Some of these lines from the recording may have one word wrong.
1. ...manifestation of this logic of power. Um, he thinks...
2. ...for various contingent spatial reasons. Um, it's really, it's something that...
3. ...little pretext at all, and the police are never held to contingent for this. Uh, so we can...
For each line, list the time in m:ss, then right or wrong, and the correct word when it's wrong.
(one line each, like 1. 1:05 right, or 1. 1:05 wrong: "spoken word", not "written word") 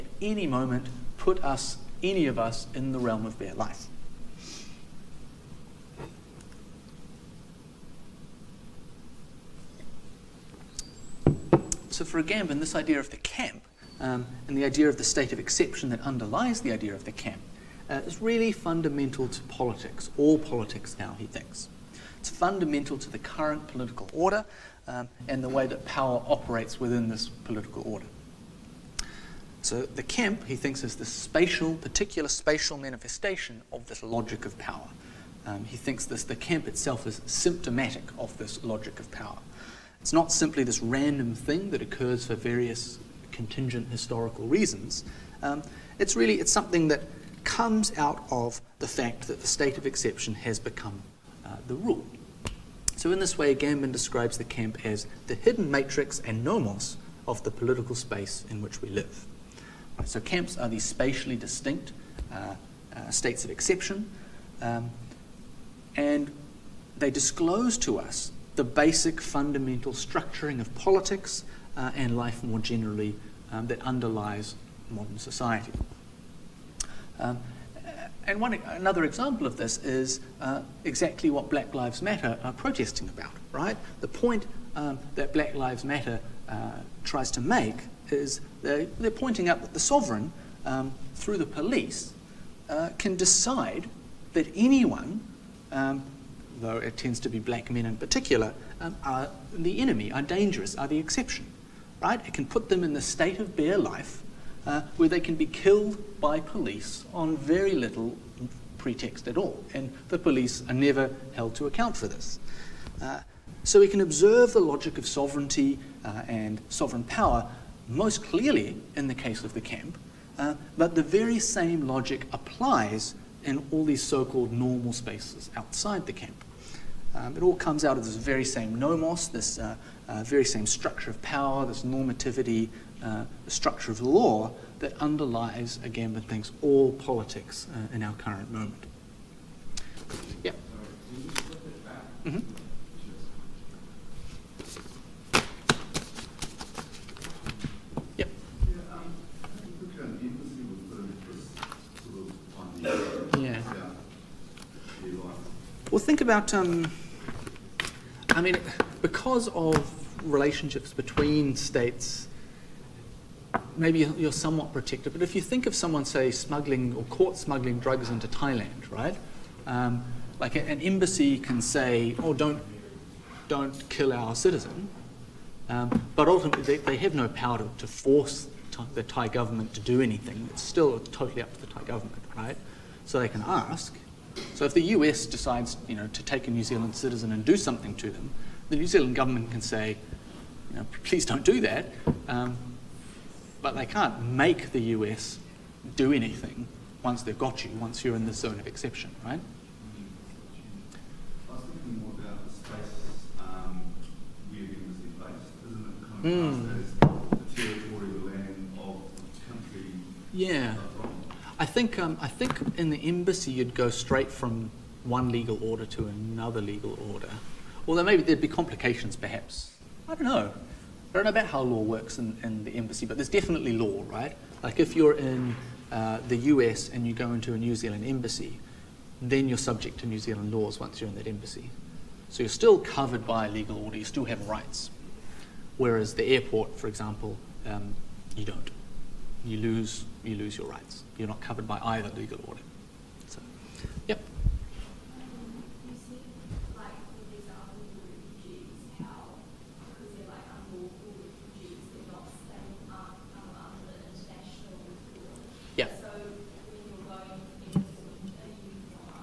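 1. 0:32 right
2. 0:42 wrong: "historical", not "spatial"
3. 1:47 wrong: "account", not "contingent".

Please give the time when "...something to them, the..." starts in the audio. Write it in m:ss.
3:07.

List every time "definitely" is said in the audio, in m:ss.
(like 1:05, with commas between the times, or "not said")
3:43.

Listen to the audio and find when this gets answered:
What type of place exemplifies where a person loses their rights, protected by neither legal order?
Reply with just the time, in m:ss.
3:56.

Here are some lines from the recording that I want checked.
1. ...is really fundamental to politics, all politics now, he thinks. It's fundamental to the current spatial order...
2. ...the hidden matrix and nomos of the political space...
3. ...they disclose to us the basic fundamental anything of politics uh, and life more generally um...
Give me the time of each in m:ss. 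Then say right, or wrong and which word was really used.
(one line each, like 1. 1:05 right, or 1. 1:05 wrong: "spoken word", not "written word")
1. 0:18 wrong: "political", not "spatial"
2. 0:55 right
3. 1:06 wrong: "structuring", not "anything".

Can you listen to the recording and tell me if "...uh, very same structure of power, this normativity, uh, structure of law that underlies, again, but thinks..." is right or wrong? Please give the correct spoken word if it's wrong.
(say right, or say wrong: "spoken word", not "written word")
right.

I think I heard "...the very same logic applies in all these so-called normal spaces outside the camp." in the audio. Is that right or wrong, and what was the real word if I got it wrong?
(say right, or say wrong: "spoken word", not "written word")
right.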